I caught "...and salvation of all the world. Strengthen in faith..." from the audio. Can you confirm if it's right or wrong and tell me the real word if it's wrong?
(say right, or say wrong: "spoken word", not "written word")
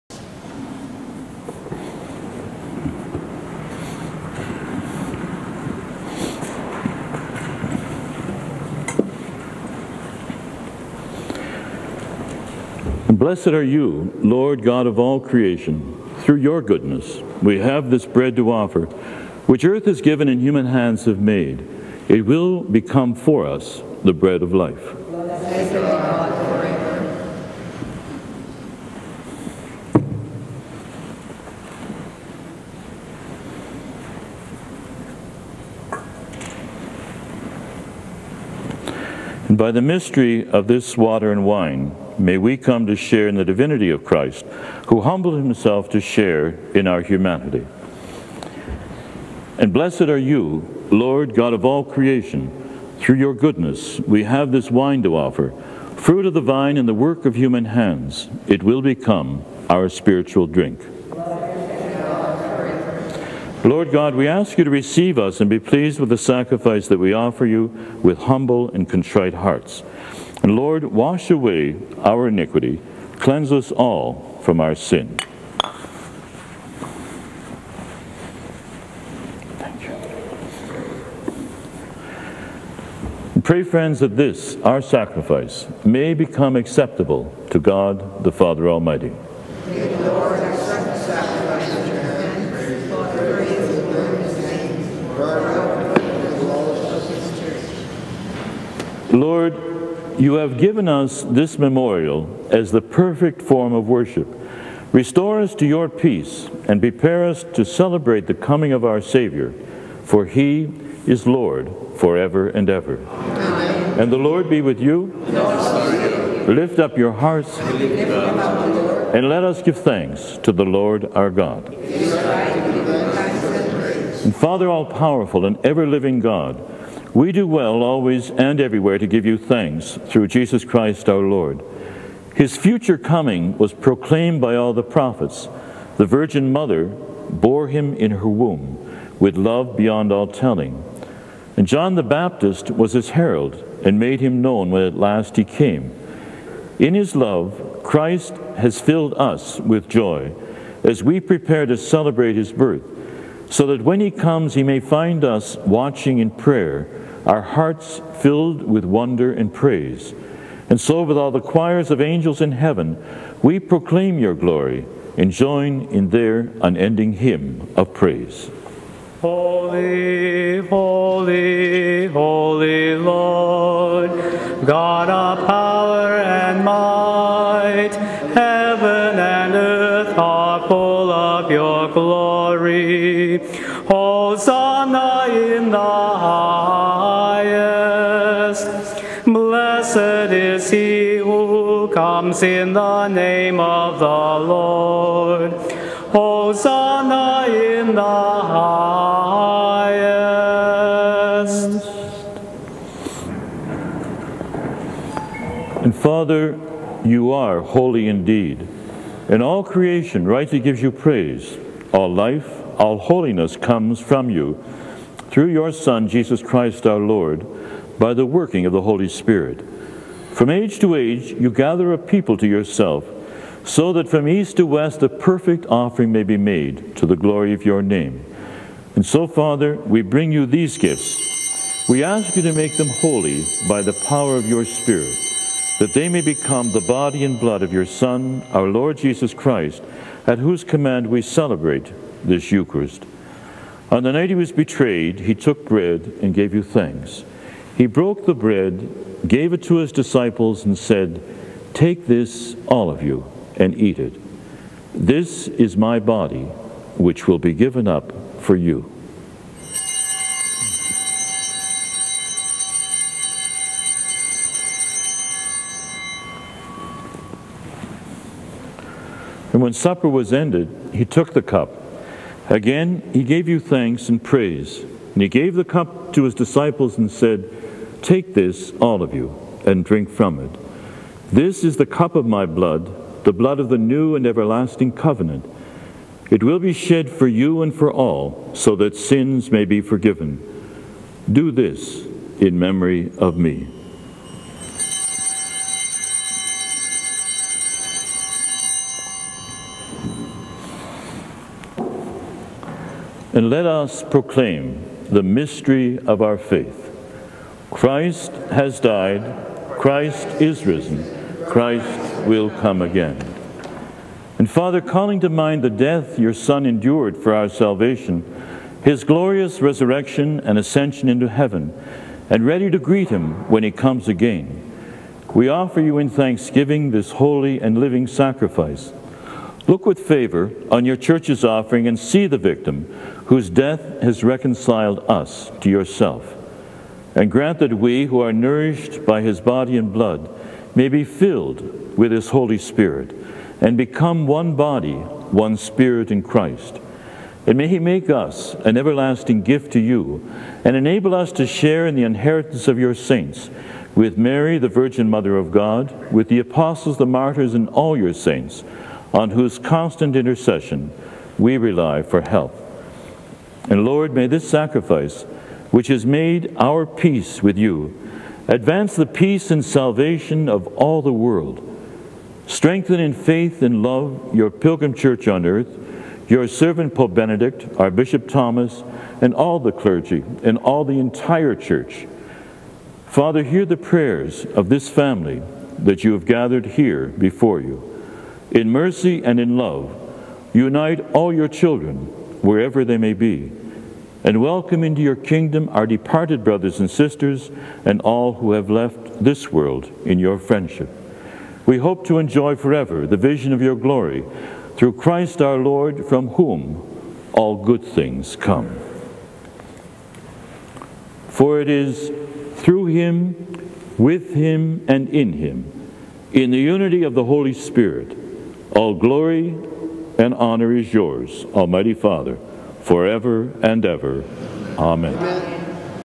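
right.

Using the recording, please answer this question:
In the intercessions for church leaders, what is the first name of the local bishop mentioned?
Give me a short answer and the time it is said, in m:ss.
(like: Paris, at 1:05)
Thomas, at 6:18.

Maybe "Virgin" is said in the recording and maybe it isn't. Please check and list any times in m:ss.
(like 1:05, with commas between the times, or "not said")
2:16, 5:54.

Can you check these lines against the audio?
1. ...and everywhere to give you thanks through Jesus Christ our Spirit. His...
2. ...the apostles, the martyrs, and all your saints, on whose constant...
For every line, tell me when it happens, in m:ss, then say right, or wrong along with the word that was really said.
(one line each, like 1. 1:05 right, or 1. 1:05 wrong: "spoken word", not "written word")
1. 2:08 wrong: "Lord", not "Spirit"
2. 5:56 right.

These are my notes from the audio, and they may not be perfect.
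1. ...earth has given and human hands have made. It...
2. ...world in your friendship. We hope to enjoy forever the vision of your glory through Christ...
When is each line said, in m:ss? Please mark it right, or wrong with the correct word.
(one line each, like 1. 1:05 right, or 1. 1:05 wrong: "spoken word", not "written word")
1. 0:19 right
2. 6:39 right.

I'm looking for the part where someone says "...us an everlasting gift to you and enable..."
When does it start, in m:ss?
5:48.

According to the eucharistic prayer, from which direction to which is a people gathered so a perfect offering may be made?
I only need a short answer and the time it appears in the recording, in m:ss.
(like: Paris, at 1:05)
east to west, at 3:44.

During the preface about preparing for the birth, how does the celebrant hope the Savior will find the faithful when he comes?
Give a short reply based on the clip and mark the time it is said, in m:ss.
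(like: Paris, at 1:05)
watching in prayer, at 2:35.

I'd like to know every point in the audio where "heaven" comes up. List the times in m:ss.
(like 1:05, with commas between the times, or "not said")
2:42, 2:58, 5:21.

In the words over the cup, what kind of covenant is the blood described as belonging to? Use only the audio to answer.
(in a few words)
new and everlasting.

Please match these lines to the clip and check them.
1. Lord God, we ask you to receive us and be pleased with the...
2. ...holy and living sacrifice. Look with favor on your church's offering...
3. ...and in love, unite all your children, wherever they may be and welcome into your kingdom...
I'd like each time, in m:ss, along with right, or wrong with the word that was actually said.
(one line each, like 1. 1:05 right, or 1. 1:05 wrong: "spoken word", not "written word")
1. 1:03 right
2. 5:27 right
3. 6:29 right.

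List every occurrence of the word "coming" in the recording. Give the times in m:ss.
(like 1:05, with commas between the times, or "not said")
1:48, 2:12.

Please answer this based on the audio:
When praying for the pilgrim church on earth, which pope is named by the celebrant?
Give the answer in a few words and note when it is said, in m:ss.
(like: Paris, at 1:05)
Pope Benedict, at 6:16.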